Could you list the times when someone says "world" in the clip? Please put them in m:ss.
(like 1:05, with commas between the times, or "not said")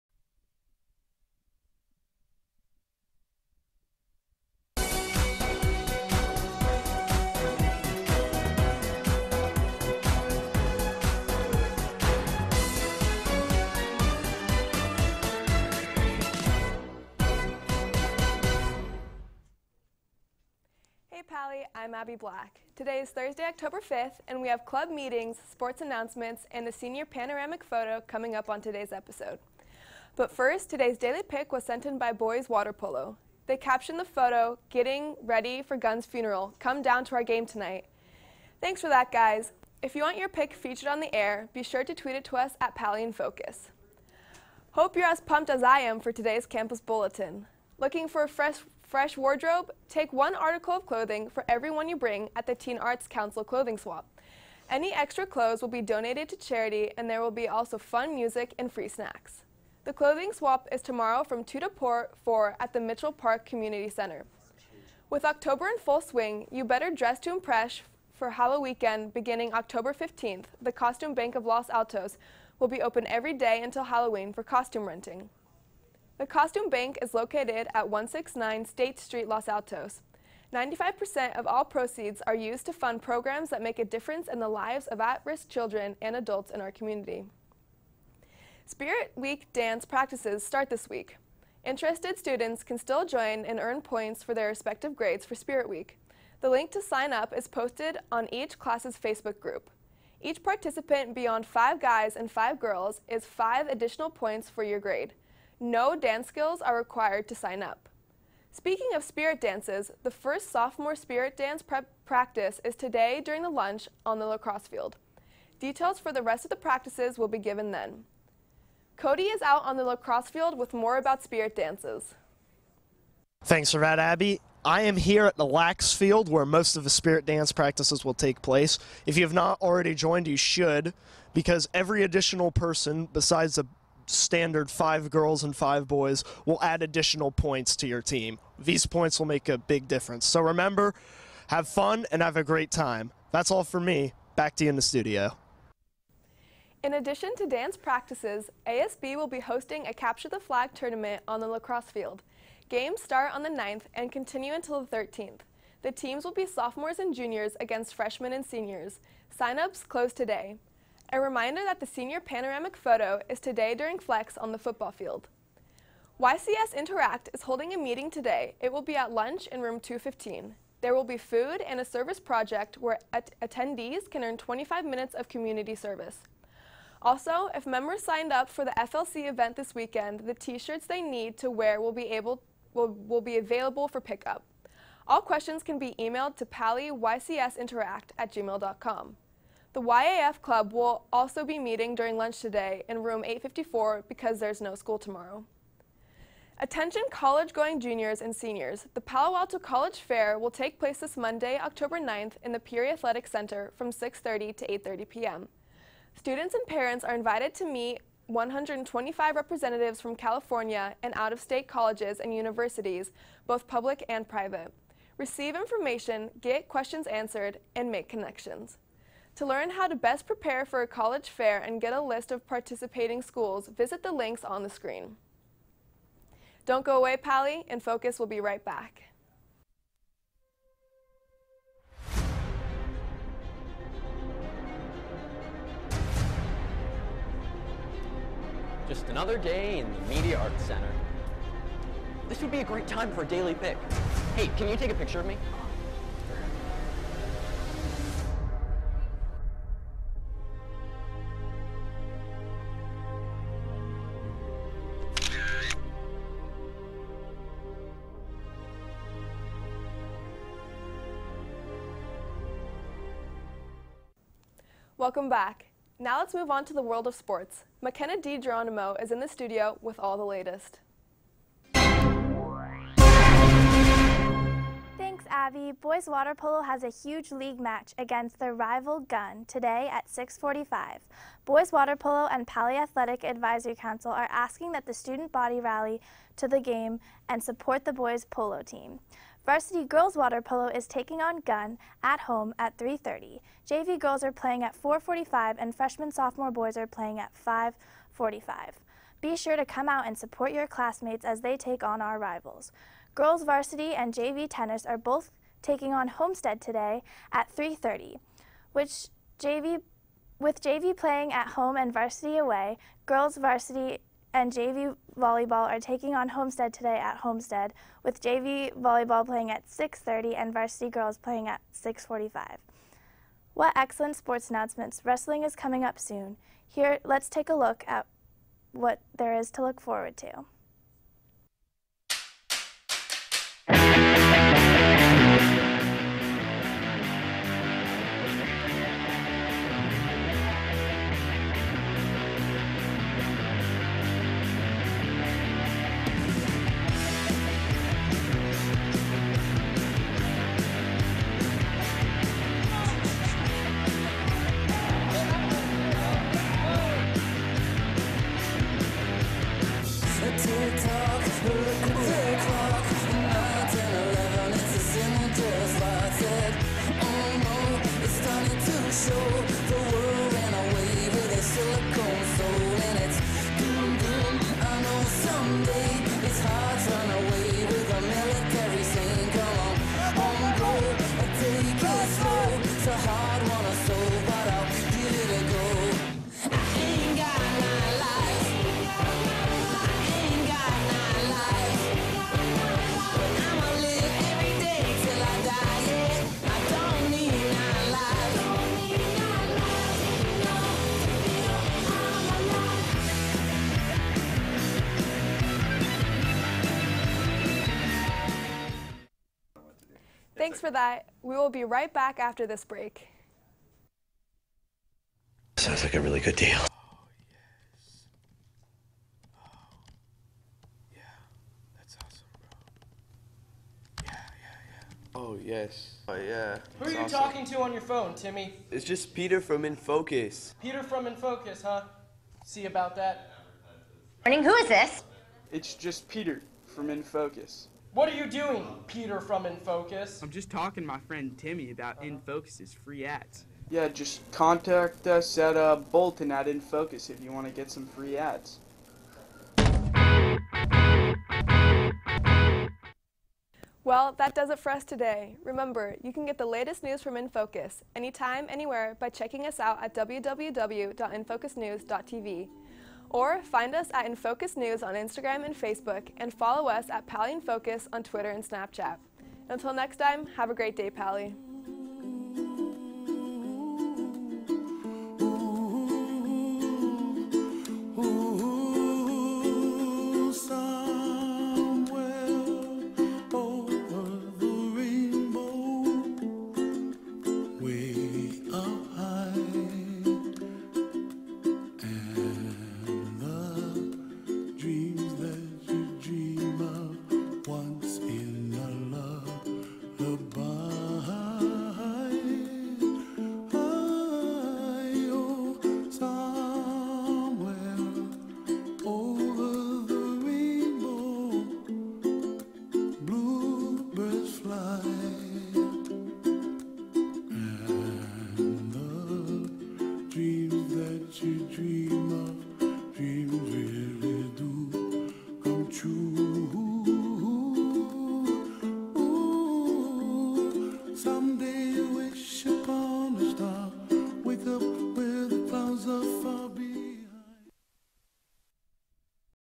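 4:26.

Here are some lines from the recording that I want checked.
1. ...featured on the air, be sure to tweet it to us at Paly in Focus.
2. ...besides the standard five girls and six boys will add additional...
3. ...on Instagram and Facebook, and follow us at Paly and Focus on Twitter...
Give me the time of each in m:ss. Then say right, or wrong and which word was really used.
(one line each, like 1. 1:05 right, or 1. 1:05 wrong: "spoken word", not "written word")
1. 0:40 right
2. 2:13 wrong: "five", not "six"
3. 7:44 right.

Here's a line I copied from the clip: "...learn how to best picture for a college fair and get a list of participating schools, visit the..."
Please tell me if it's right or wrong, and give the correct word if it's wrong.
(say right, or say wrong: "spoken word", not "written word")
wrong: "prepare", not "picture".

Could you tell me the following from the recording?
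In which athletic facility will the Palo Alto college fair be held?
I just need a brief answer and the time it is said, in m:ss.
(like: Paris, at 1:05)
Peery Athletic Center, at 3:22.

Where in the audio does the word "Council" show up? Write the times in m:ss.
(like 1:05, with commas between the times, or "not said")
0:53, 4:43.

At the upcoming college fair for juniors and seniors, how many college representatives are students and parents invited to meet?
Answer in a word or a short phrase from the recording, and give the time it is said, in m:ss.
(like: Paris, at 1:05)
125, at 3:28.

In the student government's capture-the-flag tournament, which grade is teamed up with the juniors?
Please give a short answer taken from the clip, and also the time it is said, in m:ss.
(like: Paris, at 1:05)
Sophomores, at 2:36.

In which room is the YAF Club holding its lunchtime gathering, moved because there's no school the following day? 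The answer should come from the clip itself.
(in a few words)
854.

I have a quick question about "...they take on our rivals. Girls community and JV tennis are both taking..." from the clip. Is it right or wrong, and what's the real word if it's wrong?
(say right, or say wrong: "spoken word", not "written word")
wrong: "varsity", not "community".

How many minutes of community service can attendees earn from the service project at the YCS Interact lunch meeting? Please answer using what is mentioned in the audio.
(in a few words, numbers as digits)
25.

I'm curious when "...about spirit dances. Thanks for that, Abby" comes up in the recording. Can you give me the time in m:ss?
2:00.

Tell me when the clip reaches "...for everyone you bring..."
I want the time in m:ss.
0:51.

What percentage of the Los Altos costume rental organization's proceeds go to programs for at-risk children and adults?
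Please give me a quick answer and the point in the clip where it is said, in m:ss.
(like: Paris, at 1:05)
95%, at 1:20.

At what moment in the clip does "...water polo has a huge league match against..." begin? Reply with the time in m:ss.
4:36.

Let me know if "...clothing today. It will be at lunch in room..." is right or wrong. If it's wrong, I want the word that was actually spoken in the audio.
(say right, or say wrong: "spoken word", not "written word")
wrong: "meeting", not "clothing".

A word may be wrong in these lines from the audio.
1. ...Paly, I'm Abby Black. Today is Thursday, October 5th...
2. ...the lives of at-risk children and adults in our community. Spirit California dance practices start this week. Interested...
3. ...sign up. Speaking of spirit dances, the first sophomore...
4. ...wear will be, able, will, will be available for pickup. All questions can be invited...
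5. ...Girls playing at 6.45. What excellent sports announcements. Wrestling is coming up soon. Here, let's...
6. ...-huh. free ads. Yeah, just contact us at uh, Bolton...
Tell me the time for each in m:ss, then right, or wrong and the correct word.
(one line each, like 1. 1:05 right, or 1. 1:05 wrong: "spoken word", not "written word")
1. 0:21 right
2. 1:24 wrong: "Week", not "California"
3. 1:47 right
4. 3:01 wrong: "emailed", not "invited"
5. 5:20 right
6. 7:22 right.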